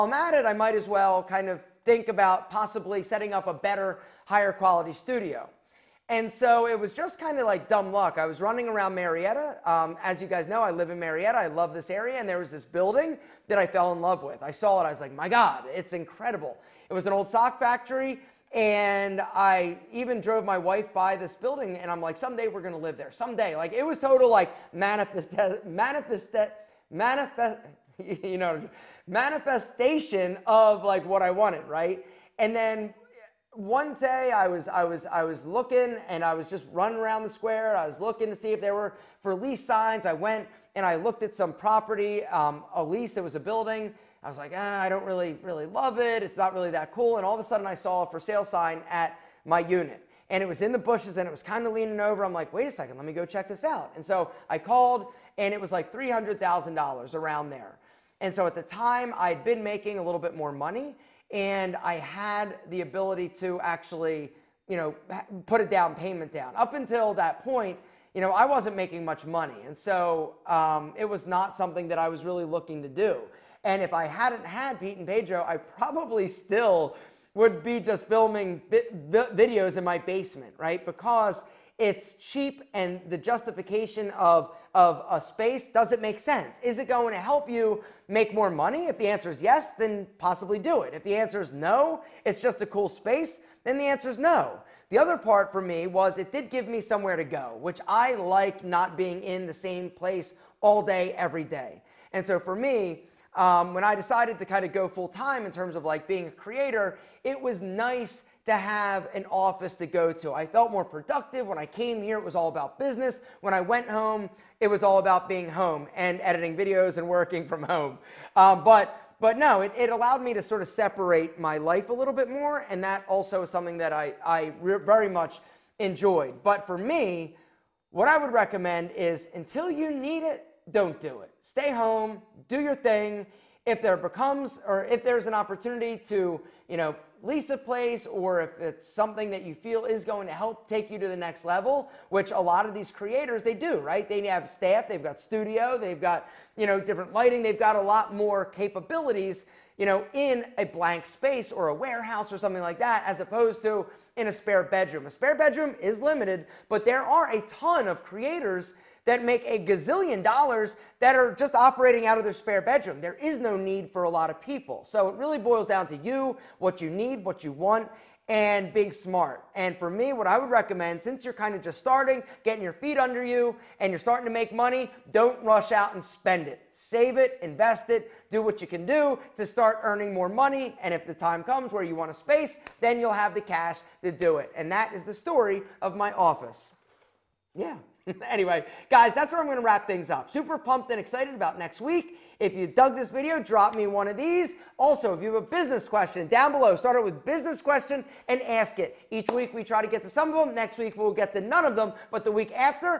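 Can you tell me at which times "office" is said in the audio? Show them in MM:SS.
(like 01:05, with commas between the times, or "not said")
01:49, 03:06.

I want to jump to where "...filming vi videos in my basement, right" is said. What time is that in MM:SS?
01:18.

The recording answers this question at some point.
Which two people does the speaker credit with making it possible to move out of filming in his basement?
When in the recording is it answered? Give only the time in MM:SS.
01:14.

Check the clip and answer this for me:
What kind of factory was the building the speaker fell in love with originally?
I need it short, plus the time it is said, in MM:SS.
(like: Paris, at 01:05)
Sock factory, at 00:17.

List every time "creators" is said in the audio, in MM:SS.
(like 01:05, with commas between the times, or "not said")
01:46, 02:22, 02:38.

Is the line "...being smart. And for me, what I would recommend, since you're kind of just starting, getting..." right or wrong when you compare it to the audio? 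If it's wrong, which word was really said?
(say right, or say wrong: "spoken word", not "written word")
right.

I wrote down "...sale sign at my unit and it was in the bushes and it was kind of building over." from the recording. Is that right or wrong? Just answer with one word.
wrong.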